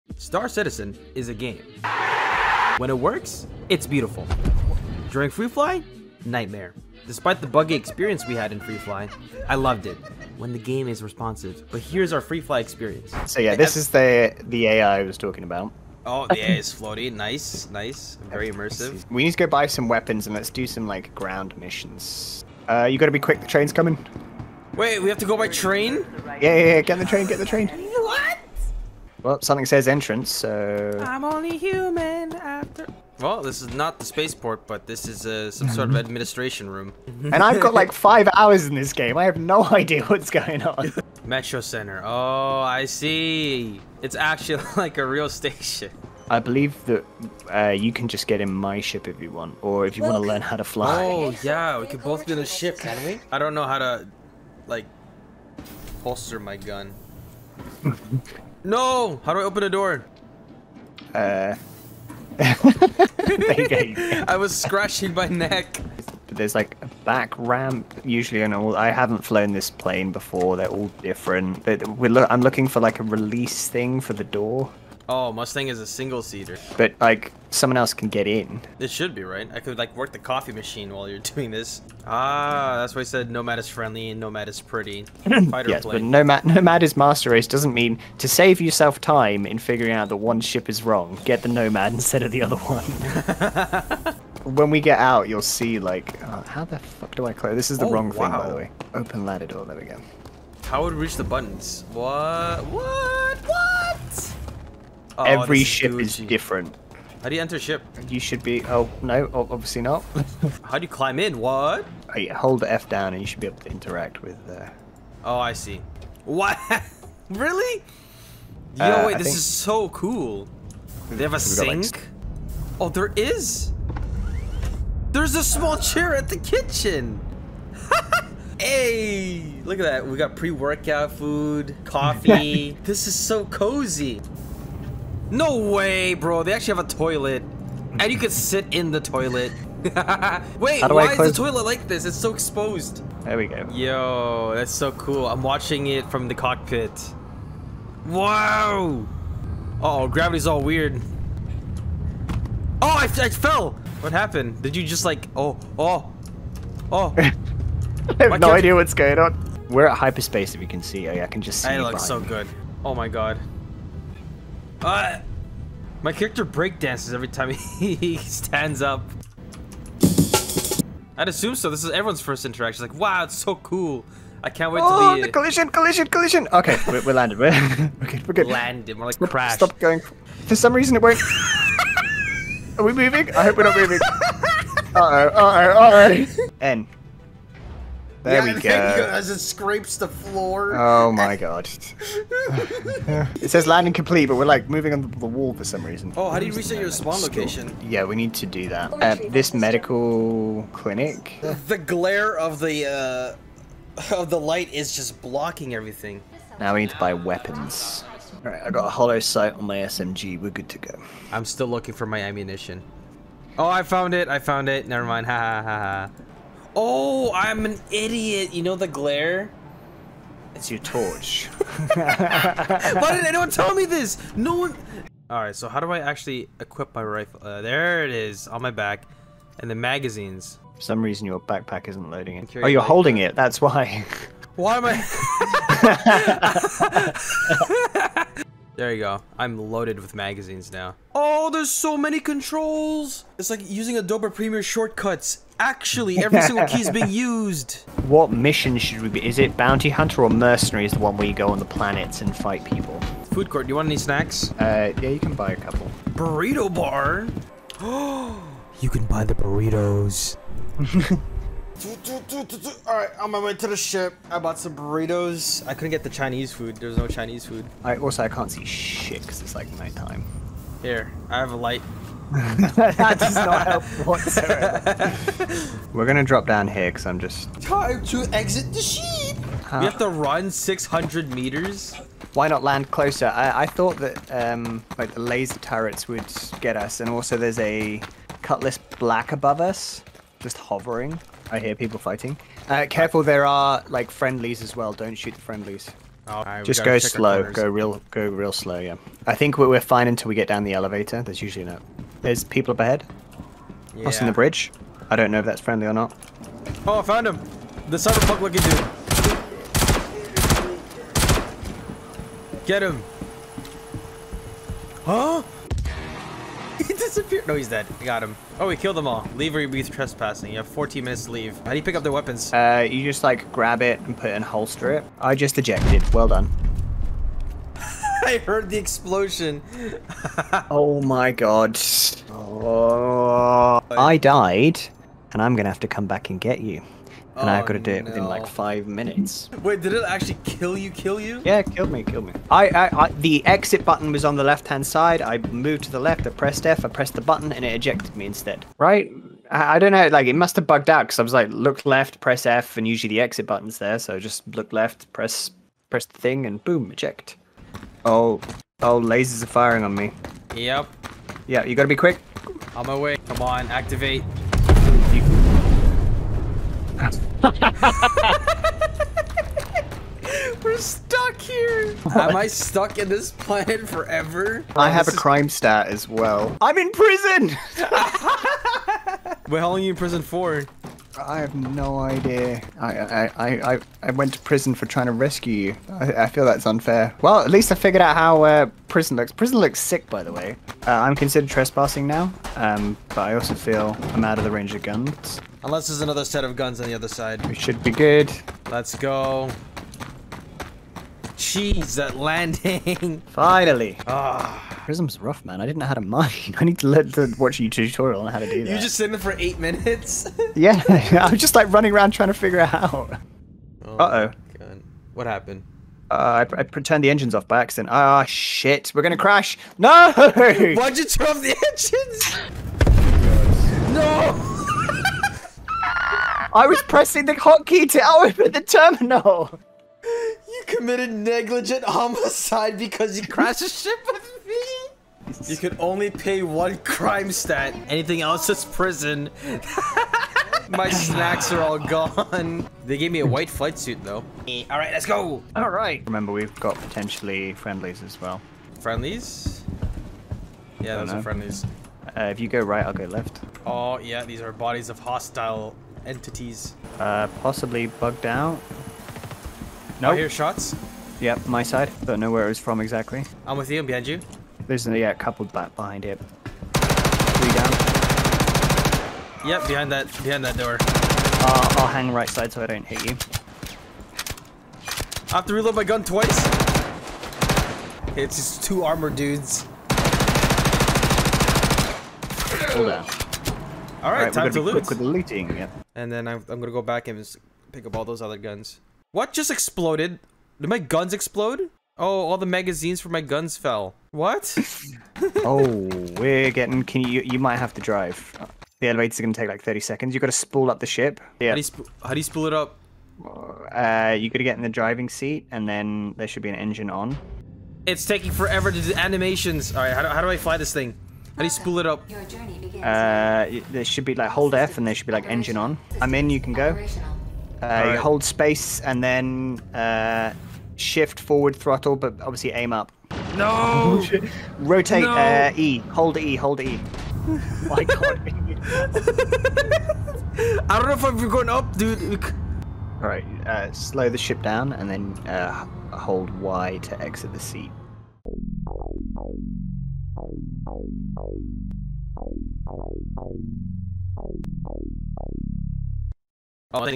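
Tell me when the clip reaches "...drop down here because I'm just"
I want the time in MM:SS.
04:36.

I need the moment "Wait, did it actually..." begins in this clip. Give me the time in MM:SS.
05:39.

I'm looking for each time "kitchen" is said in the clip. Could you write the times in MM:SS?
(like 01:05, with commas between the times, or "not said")
02:06.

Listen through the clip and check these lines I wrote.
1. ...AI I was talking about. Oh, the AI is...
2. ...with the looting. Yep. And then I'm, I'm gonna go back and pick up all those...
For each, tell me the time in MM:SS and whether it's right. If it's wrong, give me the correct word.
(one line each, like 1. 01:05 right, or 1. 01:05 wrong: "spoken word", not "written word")
1. 00:14 right
2. 08:04 right.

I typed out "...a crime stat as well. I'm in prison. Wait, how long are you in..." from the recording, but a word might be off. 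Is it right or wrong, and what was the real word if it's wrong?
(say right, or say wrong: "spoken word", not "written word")
right.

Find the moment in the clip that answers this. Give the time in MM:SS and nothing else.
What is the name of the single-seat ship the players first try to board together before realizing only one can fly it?
01:15.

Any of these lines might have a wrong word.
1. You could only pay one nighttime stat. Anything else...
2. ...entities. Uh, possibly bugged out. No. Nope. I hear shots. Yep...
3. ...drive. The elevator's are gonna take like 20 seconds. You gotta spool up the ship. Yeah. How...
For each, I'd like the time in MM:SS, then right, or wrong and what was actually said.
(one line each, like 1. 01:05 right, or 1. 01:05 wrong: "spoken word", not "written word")
1. 07:15 wrong: "crime", not "nighttime"
2. 07:36 right
3. 08:17 wrong: "30", not "20".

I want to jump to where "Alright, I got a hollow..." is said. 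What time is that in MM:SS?
03:28.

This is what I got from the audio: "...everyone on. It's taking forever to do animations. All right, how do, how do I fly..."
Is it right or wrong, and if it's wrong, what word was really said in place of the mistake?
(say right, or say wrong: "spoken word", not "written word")
wrong: "engine", not "everyone".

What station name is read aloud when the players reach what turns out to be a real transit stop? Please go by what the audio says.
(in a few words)
Metro Center.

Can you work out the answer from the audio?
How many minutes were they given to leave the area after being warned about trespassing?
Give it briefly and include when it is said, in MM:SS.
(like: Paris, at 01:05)
14, at 05:20.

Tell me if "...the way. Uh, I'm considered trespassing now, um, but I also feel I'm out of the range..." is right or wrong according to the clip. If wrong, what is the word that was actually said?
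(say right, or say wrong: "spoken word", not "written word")
right.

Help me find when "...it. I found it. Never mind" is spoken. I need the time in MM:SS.
03:34.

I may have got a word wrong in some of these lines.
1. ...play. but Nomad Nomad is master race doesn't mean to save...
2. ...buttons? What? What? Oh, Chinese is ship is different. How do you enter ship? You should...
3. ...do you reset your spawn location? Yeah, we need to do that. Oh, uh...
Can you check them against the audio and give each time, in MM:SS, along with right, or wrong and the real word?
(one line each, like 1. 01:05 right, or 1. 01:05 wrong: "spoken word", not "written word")
1. 01:25 right
2. 01:41 wrong: "Every", not "Chinese"
3. 03:16 right.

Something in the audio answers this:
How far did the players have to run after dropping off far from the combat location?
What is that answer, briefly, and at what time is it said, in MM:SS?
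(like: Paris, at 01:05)
600 meters, at 04:40.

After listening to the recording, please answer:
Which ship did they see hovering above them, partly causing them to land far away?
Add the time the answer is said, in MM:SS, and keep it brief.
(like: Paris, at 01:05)
Cutlass Black, at 04:48.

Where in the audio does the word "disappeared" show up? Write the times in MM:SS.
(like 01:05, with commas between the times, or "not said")
05:16.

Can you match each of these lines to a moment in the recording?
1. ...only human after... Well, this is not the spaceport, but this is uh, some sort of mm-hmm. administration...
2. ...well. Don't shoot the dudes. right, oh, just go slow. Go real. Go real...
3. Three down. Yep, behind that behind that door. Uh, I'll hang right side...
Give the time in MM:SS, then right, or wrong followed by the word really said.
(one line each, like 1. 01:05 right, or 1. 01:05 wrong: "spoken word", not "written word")
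1. 00:31 right
2. 04:54 wrong: "friendlies", not "dudes"
3. 07:46 right.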